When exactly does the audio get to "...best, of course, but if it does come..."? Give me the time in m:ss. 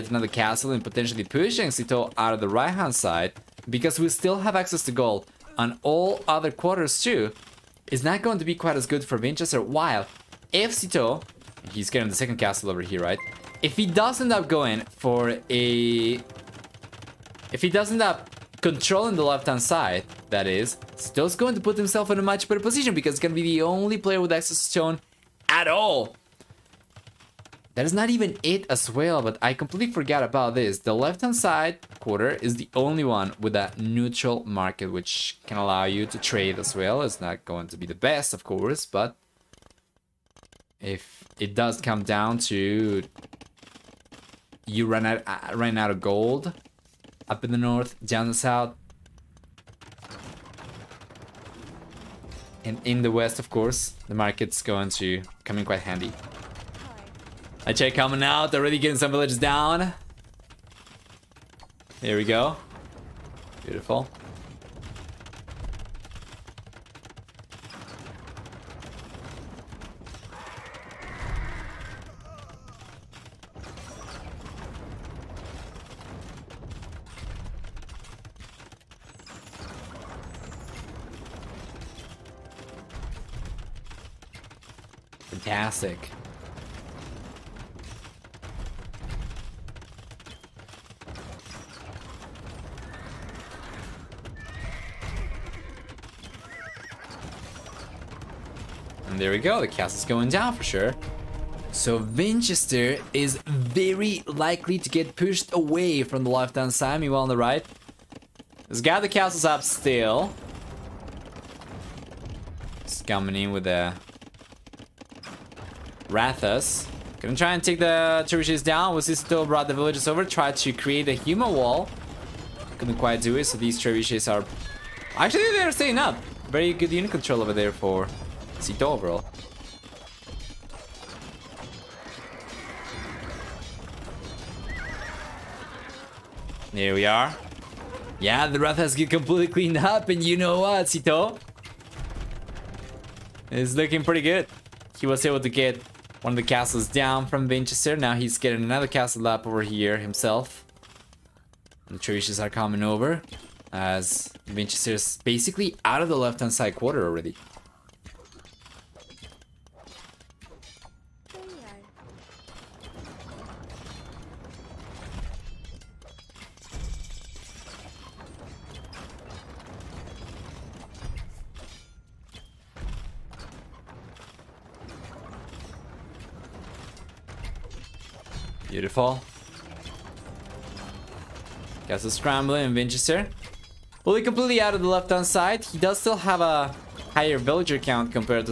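0:37.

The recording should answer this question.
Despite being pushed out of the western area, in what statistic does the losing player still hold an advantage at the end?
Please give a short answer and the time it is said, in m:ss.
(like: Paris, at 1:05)
Villager count, at 3:07.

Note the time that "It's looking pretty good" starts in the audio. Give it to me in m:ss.
2:23.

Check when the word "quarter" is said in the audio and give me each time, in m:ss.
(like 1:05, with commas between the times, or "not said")
0:06, 0:31, 2:36.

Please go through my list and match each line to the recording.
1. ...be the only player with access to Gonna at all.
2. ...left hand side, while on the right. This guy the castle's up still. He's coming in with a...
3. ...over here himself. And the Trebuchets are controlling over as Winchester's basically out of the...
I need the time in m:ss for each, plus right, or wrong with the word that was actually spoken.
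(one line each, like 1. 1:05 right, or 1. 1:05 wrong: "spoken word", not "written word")
1. 0:23 wrong: "Stone", not "Gonna"
2. 1:46 wrong: "meanwhile", not "while"
3. 2:29 wrong: "coming", not "controlling".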